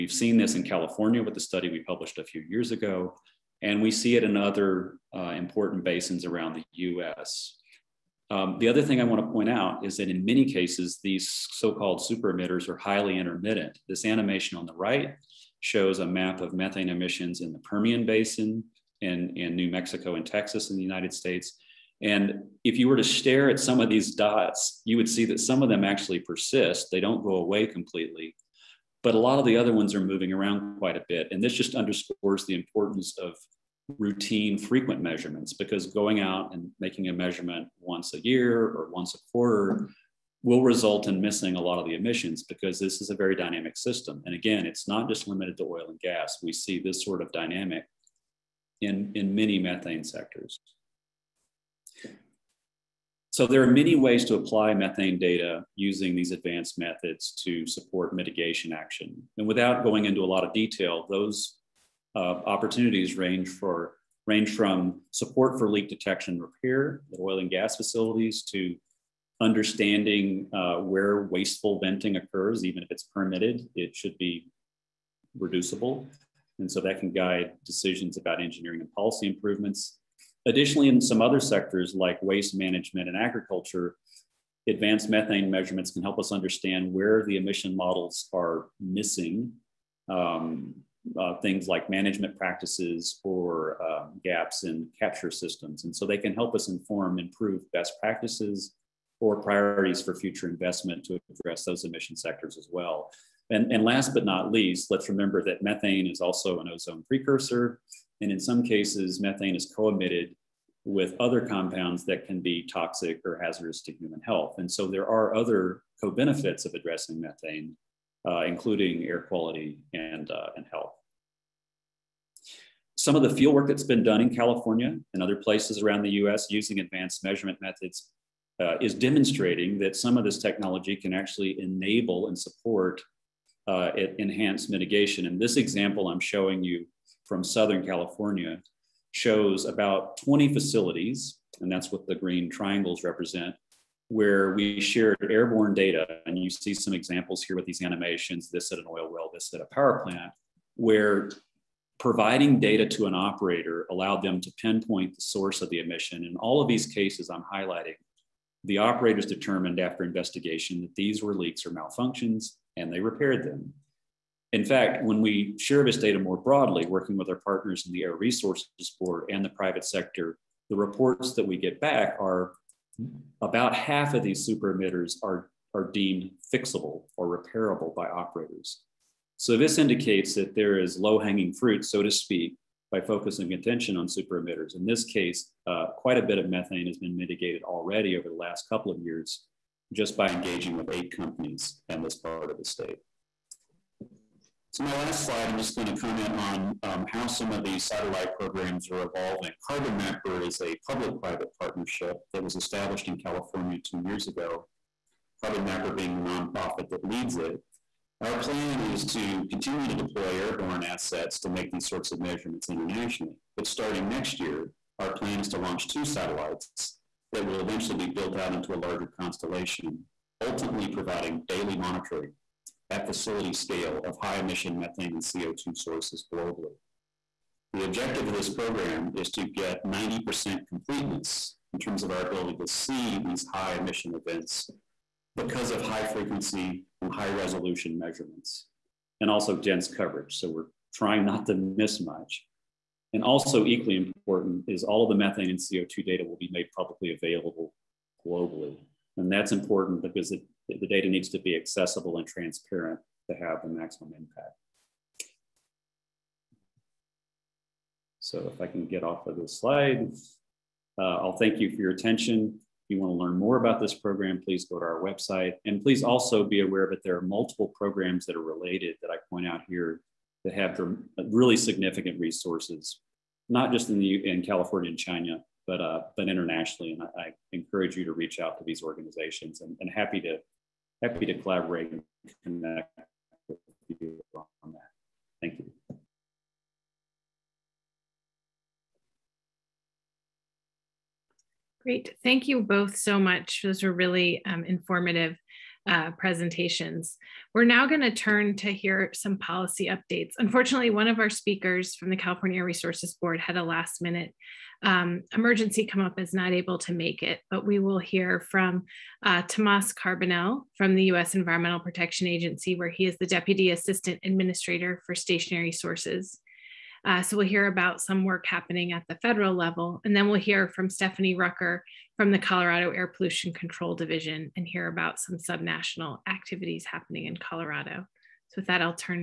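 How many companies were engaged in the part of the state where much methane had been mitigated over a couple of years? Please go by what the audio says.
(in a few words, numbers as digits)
8.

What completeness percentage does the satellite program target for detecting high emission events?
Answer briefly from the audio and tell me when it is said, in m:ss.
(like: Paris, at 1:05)
90%, at 3:49.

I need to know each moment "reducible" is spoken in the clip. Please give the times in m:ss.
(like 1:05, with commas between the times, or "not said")
1:15.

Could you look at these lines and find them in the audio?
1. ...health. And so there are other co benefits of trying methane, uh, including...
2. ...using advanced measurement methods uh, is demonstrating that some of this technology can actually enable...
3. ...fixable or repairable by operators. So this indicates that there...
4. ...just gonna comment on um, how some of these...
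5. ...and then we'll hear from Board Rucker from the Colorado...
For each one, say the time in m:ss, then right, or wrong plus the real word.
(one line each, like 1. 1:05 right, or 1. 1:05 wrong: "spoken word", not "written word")
1. 1:54 wrong: "addressing", not "trying"
2. 2:06 right
3. 2:56 right
4. 3:15 right
5. 5:20 wrong: "Stephanie", not "Board".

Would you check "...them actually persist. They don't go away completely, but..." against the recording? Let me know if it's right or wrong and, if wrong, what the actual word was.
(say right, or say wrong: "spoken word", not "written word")
right.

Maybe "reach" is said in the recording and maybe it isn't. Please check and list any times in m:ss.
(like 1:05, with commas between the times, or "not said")
4:38.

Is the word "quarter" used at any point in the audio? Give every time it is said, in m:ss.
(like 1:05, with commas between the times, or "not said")
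0:39.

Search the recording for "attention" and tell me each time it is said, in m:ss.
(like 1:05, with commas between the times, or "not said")
3:03, 4:21.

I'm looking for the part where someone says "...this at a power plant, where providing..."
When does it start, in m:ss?
2:29.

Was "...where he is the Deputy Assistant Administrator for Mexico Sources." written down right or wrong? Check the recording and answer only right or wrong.
wrong.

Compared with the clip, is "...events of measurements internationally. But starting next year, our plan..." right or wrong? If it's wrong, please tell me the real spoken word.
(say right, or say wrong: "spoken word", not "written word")
wrong: "sorts", not "events".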